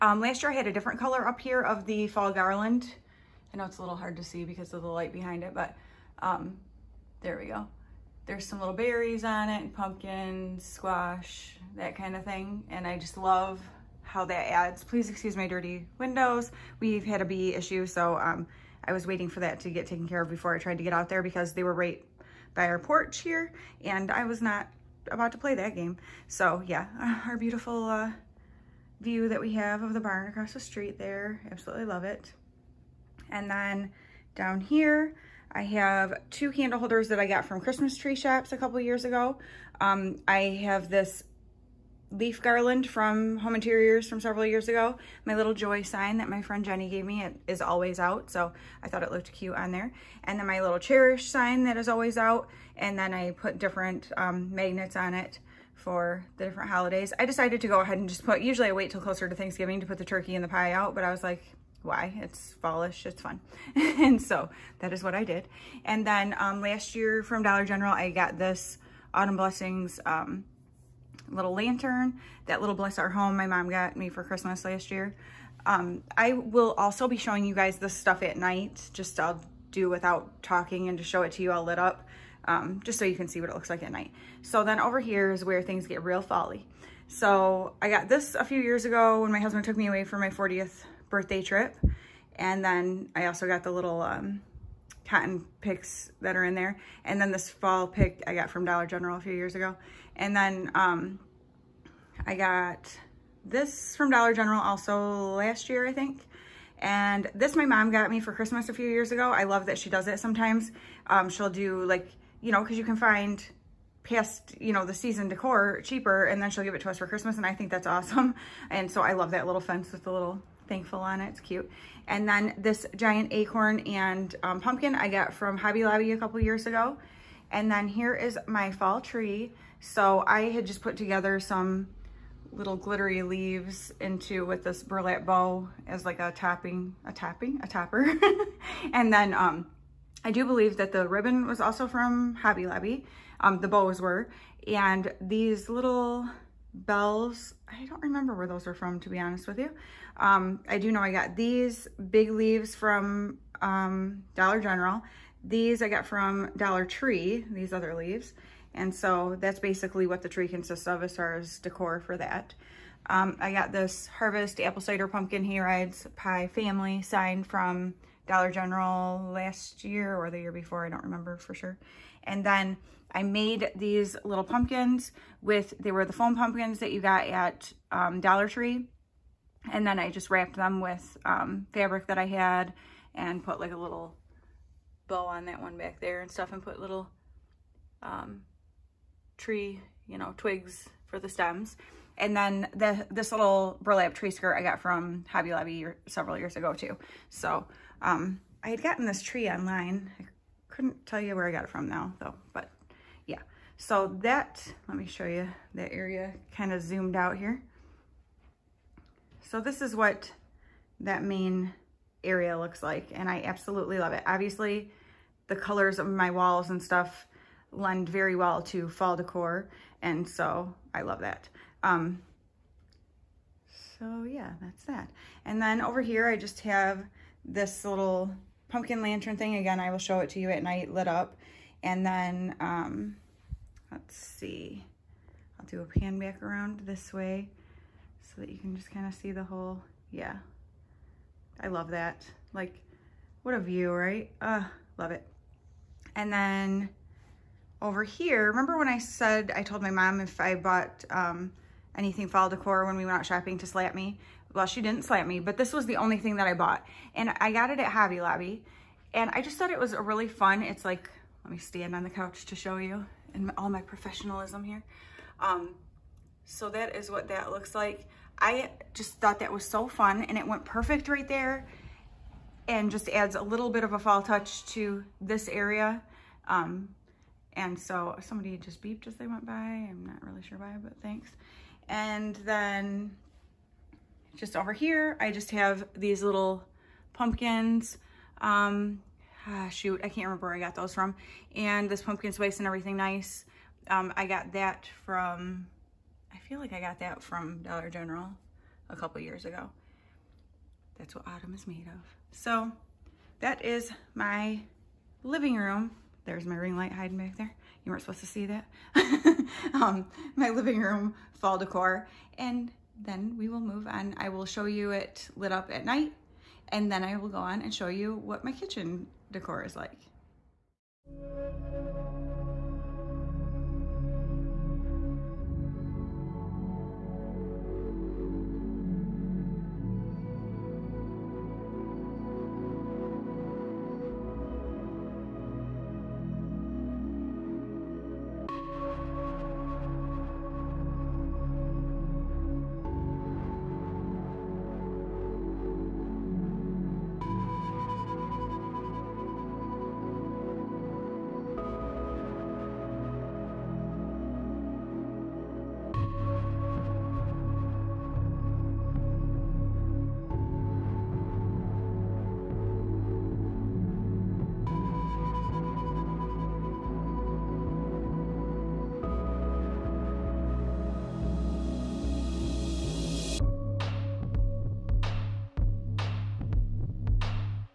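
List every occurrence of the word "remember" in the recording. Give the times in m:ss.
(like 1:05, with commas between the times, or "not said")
2:28, 2:51, 4:08, 4:50.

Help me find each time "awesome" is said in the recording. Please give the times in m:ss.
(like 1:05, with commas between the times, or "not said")
1:57.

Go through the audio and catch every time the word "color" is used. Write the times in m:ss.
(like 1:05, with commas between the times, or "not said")
0:00, 3:35.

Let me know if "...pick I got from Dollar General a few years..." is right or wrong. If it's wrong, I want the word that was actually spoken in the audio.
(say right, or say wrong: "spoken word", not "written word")
right.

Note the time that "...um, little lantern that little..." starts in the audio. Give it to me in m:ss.
1:10.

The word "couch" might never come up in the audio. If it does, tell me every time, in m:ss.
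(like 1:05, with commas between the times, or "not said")
4:22.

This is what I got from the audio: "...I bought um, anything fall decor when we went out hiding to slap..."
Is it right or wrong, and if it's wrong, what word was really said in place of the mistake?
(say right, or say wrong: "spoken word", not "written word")
wrong: "shopping", not "hiding".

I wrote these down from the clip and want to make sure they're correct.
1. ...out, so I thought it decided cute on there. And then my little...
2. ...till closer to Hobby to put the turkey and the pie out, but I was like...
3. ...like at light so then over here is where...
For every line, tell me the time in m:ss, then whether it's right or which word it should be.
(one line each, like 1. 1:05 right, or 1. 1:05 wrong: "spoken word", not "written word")
1. 0:47 wrong: "looked", not "decided"
2. 0:58 wrong: "Thanksgiving", not "Hobby"
3. 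1:23 wrong: "night", not "light".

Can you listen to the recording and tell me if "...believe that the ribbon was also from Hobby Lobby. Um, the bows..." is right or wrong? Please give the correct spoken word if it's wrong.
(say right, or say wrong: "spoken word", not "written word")
right.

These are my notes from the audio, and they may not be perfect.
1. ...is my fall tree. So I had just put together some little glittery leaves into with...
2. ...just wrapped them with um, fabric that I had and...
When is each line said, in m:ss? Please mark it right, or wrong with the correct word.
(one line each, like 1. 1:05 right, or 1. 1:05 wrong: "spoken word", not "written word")
1. 2:08 right
2. 3:00 right.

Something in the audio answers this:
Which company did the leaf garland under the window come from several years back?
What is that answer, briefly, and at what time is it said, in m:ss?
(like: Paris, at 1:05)
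Home Interiors, at 0:43.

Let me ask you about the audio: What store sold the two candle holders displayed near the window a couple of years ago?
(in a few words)
Christmas Tree Shops.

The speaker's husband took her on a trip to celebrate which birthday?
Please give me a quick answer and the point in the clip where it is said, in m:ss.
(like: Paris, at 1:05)
40th, at 1:30.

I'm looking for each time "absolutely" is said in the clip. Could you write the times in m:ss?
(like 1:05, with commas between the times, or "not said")
0:31, 3:33.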